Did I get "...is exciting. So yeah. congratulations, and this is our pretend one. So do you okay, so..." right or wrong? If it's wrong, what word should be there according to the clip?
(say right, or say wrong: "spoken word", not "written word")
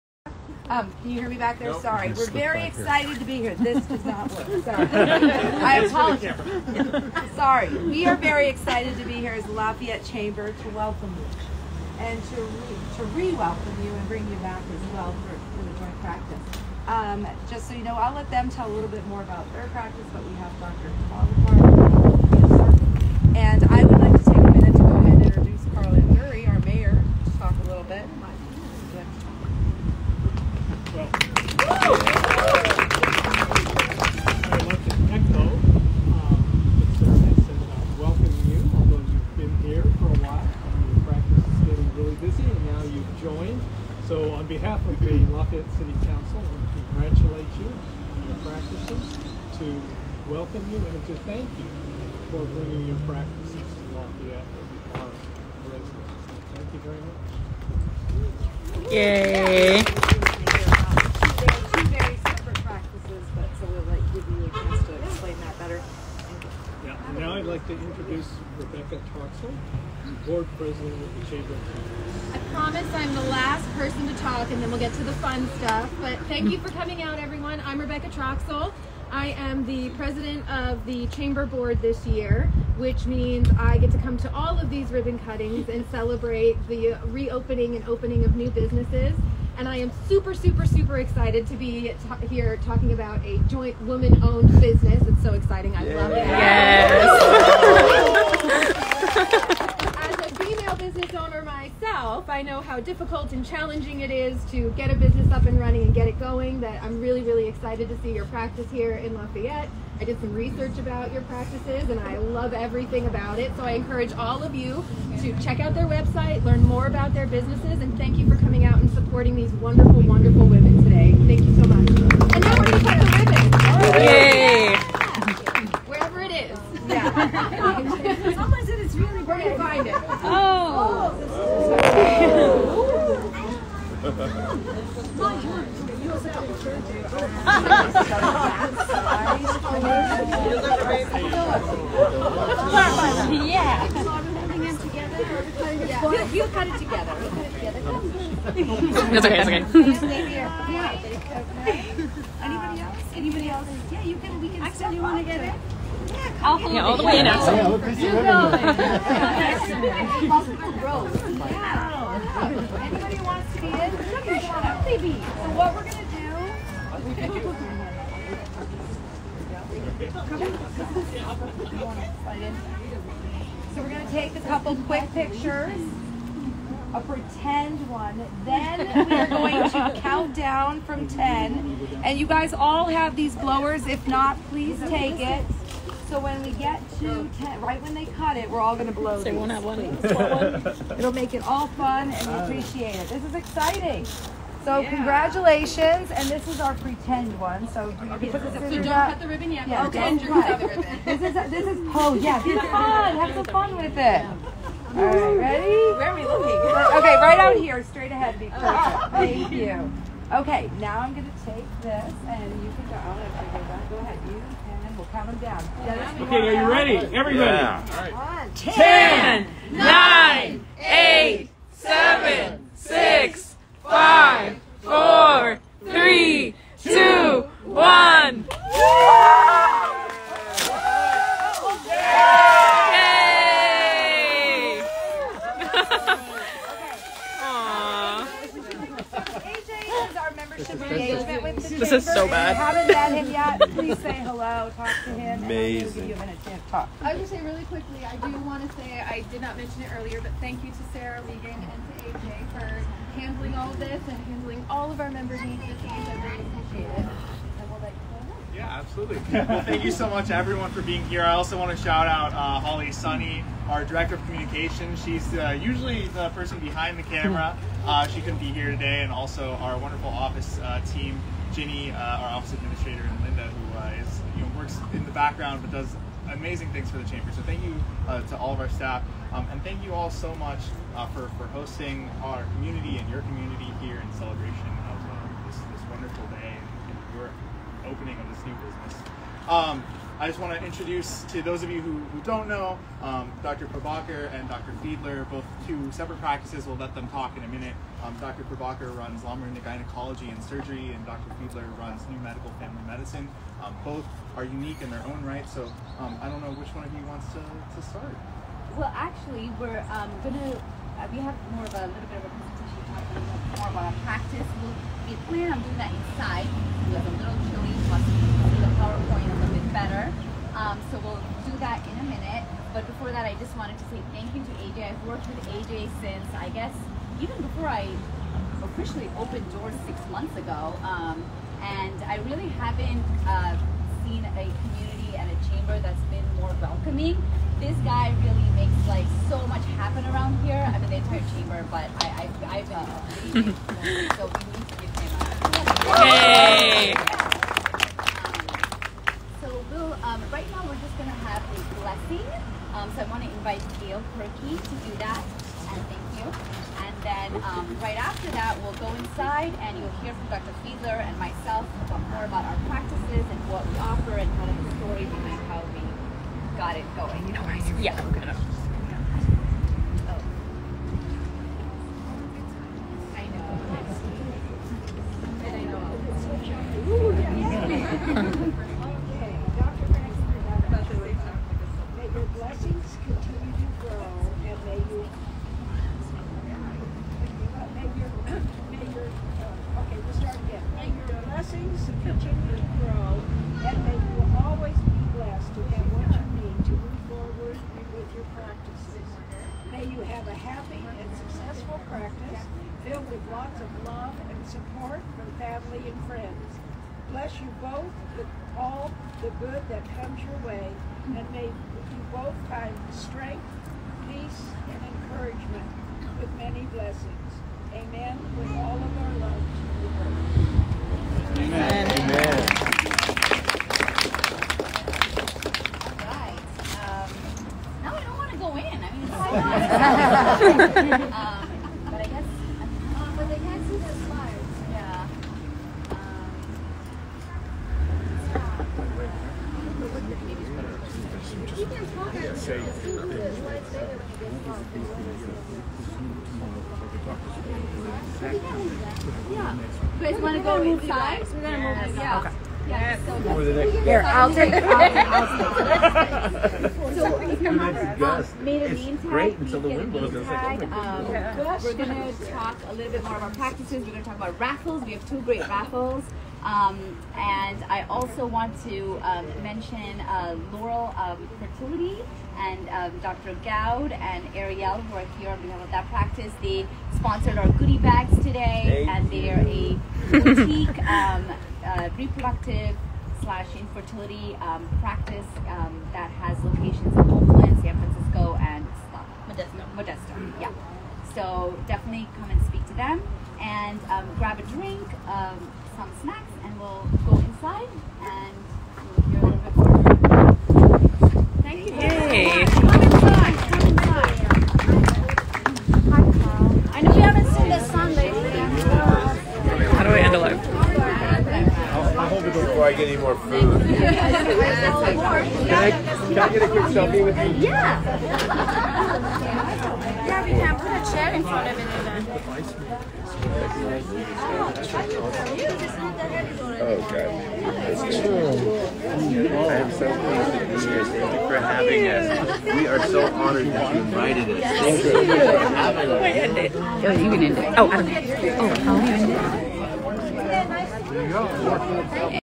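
right.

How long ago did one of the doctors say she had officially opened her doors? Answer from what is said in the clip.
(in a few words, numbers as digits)
6 months ago.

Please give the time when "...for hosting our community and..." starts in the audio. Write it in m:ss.
4:41.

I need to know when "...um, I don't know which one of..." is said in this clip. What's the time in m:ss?
5:05.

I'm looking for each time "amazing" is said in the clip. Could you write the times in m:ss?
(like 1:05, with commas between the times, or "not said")
4:05, 4:36.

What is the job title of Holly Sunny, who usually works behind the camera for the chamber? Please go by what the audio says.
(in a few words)
director of communications.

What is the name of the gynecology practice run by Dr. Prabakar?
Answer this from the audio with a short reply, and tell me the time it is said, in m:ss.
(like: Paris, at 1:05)
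Lamorinda Gynecology and Surgery, at 4:59.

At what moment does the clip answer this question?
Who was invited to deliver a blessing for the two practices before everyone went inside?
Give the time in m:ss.
5:53.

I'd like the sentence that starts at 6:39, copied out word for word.
May you have a happy and successful practice filled with lots of love and support from family and friends.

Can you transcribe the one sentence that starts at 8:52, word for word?
We are so honored that you invited us.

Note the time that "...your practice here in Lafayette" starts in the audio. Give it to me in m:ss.
1:48.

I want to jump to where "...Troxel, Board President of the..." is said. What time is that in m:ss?
1:09.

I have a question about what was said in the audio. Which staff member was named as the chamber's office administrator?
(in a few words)
Ginny.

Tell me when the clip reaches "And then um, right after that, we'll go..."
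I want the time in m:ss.
5:56.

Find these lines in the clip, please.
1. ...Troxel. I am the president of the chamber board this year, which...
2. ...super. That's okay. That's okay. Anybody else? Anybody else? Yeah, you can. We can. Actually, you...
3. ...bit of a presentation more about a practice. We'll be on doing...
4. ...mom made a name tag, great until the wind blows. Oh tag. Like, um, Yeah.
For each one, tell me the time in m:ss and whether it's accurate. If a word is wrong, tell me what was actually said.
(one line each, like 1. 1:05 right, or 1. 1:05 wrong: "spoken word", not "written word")
1. 1:18 right
2. 2:26 wrong: "together", not "super"
3. 5:12 right
4. 7:37 right.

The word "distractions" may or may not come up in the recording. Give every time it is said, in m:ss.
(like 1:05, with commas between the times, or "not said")
not said.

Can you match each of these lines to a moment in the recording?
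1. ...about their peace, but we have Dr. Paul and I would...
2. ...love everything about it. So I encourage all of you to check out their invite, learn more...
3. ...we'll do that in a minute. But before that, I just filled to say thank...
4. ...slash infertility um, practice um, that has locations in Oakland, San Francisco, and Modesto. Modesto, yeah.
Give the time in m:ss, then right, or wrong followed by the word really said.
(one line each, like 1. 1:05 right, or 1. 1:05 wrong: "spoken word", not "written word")
1. 0:19 wrong: "practice", not "peace"
2. 1:52 wrong: "website", not "invite"
3. 5:21 wrong: "wanted", not "filled"
4. 8:03 right.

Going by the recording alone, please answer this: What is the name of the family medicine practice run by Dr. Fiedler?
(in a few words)
New Medical Family Medicine.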